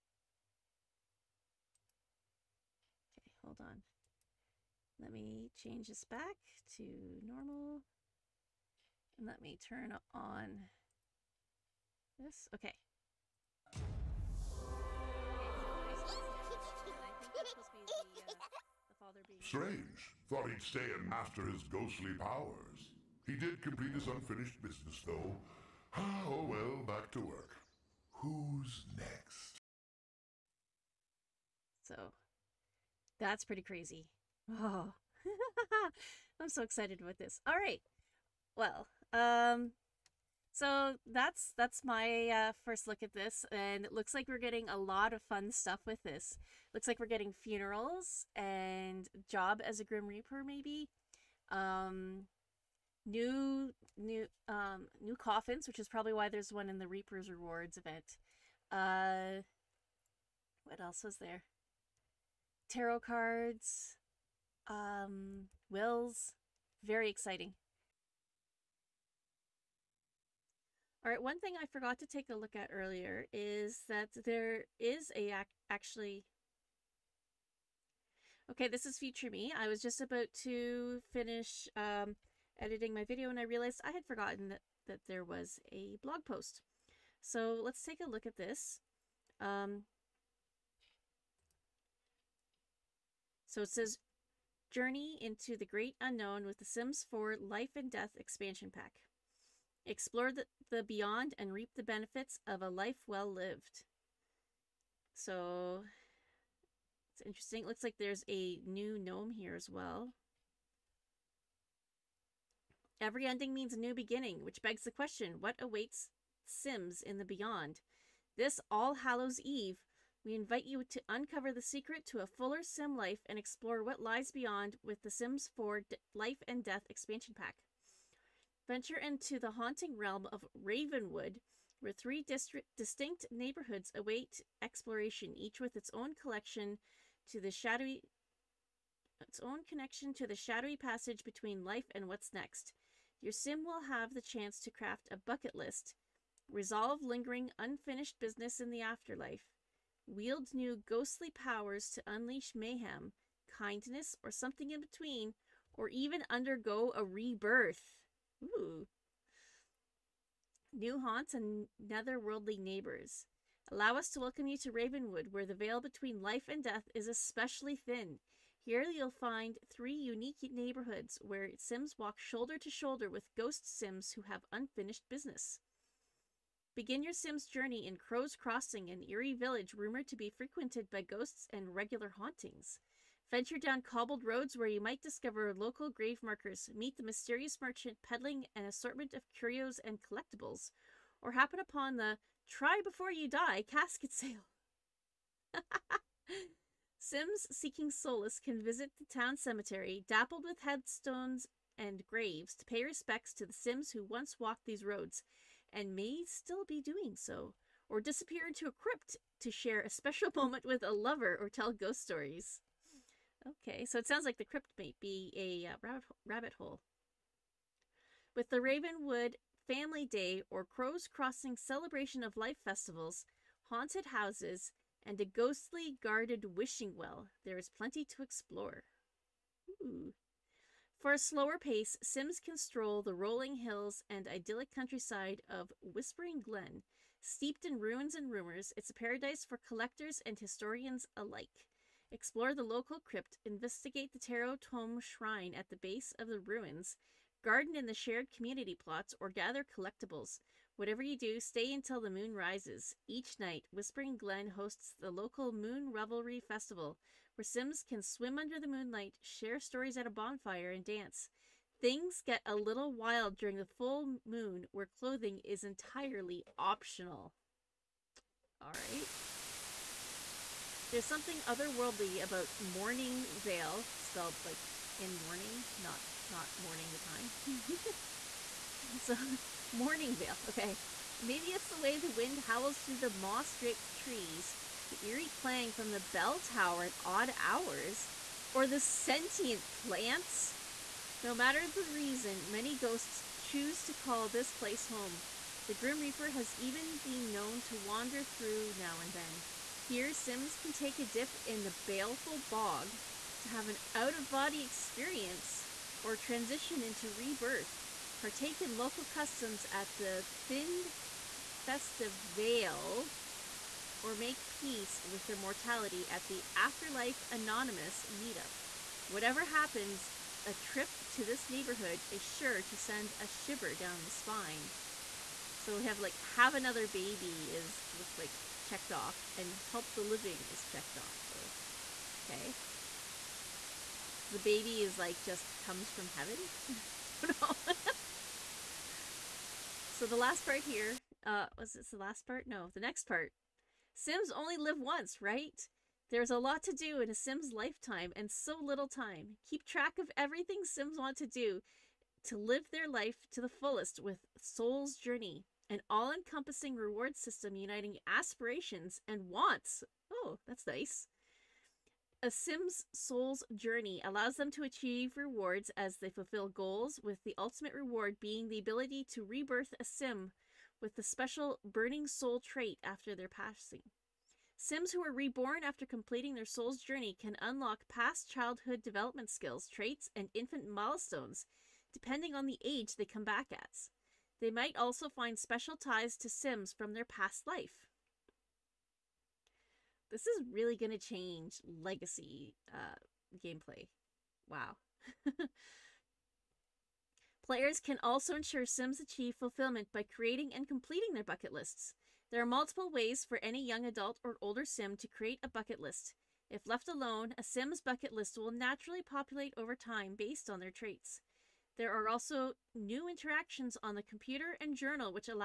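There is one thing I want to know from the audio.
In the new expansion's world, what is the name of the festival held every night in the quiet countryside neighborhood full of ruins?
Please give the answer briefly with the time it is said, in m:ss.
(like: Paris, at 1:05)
Moon Revelry Festival, at 4:15.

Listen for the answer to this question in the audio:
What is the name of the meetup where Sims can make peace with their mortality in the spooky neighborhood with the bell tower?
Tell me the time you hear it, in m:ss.
5:16.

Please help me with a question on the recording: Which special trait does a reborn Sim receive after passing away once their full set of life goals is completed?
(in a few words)
Burning Soul.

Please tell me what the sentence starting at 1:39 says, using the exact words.
Explore the, the beyond and reap the benefits of a life well lived.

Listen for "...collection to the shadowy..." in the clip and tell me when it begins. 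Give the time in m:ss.
2:16.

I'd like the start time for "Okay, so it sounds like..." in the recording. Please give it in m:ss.
3:33.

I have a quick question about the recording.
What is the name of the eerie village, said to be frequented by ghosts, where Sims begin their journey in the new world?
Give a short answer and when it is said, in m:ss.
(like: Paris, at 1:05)
Crow's Crossing, at 2:57.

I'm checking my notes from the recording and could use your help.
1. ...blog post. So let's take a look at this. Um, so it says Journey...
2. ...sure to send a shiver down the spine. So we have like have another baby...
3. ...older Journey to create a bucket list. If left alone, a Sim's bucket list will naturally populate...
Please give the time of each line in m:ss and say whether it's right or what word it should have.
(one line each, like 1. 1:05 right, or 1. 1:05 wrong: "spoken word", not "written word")
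1. 1:26 right
2. 5:22 right
3. 6:44 wrong: "Sim", not "Journey".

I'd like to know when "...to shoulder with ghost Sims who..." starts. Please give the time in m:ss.
2:52.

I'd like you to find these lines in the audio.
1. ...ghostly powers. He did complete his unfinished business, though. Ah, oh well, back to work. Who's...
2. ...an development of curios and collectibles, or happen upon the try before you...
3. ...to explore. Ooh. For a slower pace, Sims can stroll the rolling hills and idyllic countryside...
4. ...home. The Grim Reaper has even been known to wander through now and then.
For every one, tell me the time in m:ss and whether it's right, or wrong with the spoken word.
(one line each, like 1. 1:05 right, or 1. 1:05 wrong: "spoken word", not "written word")
1. 0:21 right
2. 3:08 wrong: "assortment", not "development"
3. 3:48 right
4. 4:54 right.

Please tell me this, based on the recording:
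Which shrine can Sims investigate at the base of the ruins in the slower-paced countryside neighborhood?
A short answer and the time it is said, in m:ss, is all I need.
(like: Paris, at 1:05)
Tarot Tome Shrine, at 4:04.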